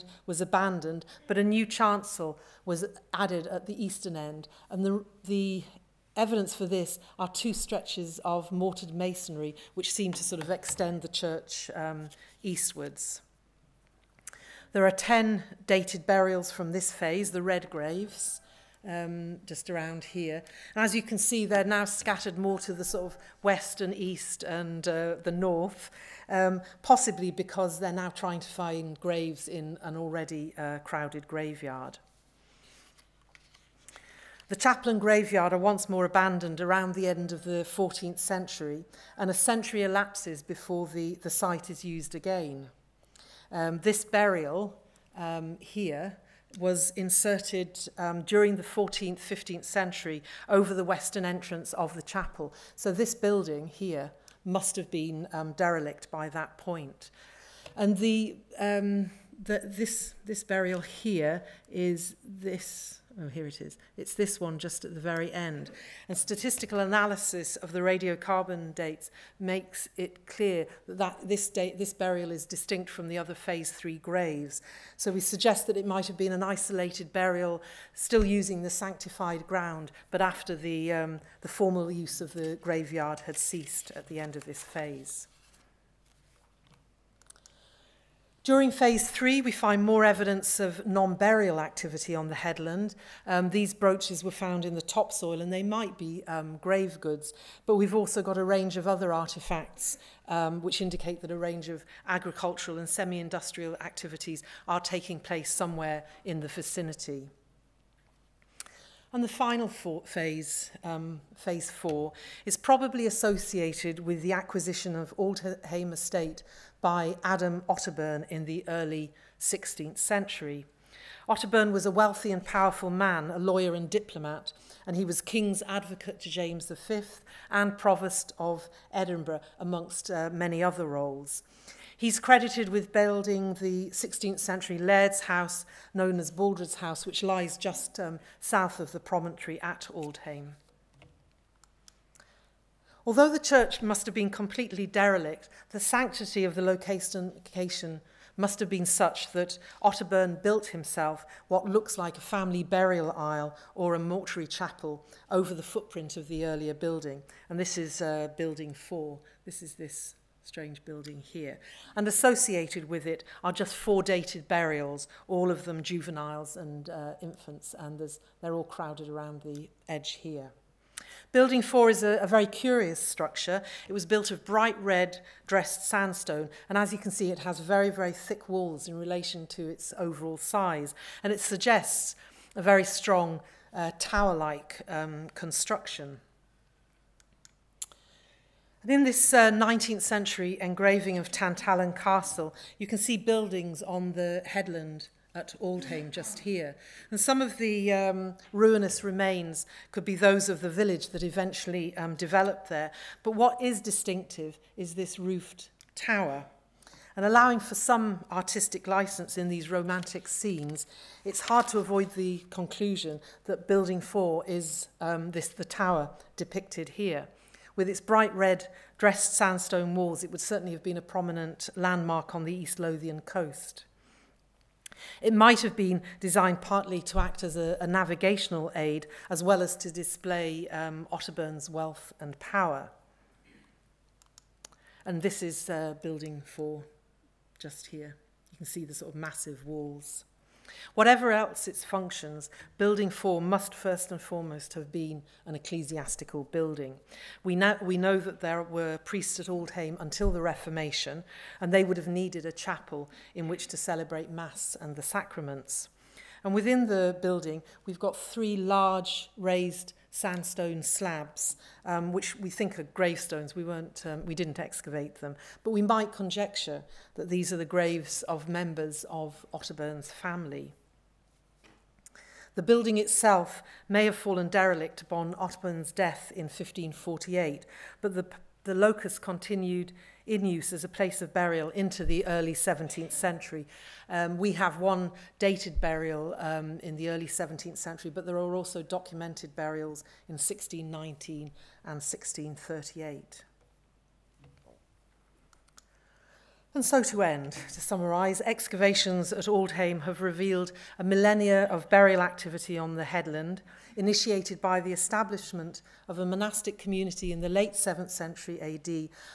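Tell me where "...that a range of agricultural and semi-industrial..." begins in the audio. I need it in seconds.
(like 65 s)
101 s.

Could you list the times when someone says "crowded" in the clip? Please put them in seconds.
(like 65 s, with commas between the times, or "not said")
30 s, 168 s.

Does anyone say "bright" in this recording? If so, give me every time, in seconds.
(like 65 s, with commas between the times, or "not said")
174 s, 218 s.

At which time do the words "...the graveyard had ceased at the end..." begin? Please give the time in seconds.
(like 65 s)
82 s.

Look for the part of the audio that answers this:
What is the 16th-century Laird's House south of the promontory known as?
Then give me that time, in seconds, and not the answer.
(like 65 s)
136 s.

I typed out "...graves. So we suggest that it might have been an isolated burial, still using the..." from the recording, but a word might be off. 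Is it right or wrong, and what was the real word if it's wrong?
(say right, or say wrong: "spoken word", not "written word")
right.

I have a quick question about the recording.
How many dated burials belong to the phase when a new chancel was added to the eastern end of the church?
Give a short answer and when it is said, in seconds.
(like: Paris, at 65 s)
10, at 14 s.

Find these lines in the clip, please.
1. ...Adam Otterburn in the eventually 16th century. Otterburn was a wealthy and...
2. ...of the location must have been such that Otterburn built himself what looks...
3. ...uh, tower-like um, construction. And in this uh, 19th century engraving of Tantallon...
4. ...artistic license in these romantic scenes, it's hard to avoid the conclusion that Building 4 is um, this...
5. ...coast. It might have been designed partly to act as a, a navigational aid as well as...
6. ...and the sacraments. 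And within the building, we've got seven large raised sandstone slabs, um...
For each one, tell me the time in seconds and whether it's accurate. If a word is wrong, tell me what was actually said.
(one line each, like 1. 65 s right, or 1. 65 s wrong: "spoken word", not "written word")
1. 117 s wrong: "early", not "eventually"
2. 146 s right
3. 183 s right
4. 208 s right
5. 223 s right
6. 254 s wrong: "three", not "seven".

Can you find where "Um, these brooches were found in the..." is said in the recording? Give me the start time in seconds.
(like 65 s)
93 s.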